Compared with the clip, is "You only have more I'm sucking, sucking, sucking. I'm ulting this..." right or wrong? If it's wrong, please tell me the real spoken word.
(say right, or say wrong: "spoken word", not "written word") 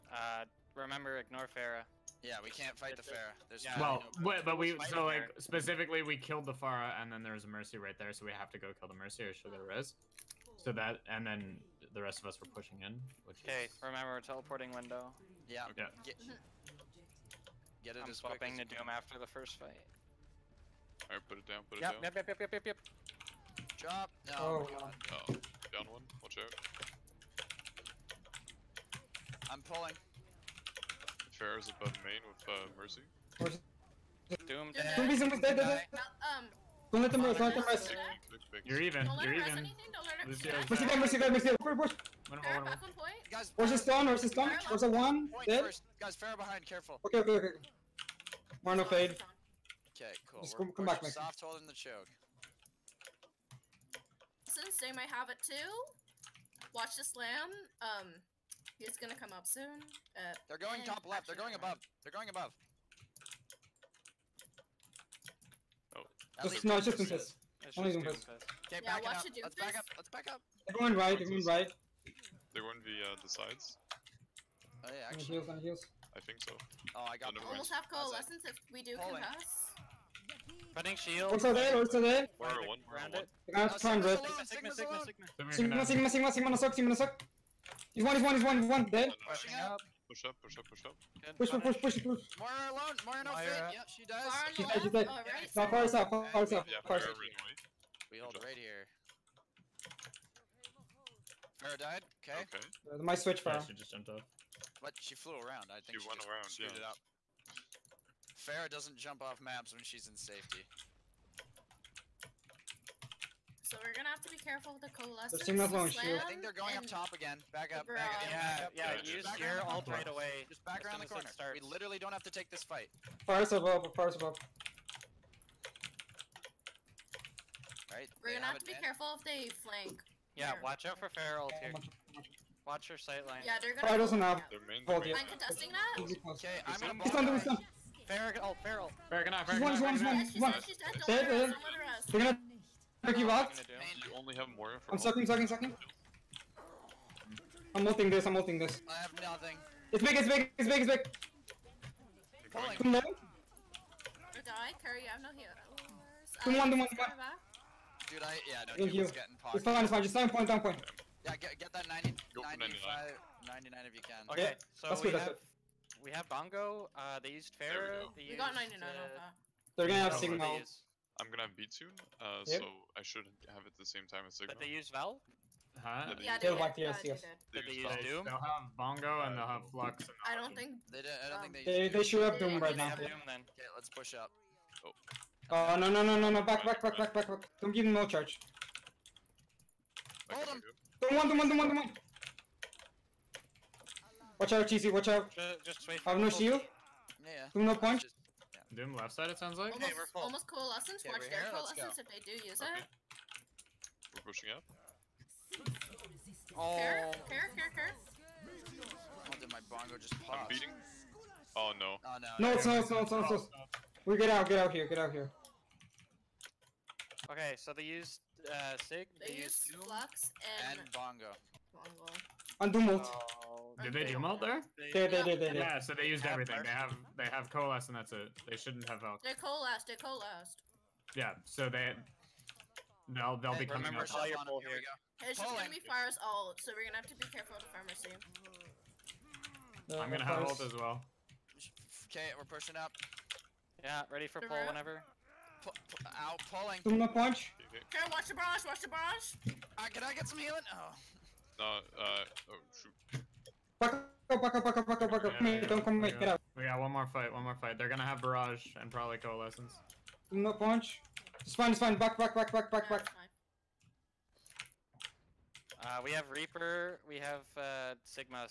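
right.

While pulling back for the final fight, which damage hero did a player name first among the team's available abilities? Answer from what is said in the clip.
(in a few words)
Reaper.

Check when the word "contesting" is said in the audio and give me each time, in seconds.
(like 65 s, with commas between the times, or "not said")
135 s.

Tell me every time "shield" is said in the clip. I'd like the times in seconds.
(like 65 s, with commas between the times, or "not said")
115 s, 196 s.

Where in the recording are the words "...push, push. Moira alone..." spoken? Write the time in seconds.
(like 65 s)
92 s.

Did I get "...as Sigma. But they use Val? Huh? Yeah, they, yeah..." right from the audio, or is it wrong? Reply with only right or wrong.
right.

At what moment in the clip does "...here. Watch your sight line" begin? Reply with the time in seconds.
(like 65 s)
131 s.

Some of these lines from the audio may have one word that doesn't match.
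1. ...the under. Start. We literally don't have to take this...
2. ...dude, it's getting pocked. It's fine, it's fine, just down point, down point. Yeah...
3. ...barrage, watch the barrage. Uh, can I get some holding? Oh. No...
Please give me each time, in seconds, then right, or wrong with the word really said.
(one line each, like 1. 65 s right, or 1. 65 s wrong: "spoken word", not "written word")
1. 120 s wrong: "corner", not "under"
2. 158 s right
3. 248 s wrong: "healing", not "holding".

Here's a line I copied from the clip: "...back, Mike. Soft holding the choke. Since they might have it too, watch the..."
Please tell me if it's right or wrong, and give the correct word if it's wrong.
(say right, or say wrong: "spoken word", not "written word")
right.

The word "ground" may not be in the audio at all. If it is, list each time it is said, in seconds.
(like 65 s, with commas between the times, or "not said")
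not said.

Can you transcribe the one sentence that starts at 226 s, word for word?
They have they have coalesce and that's it.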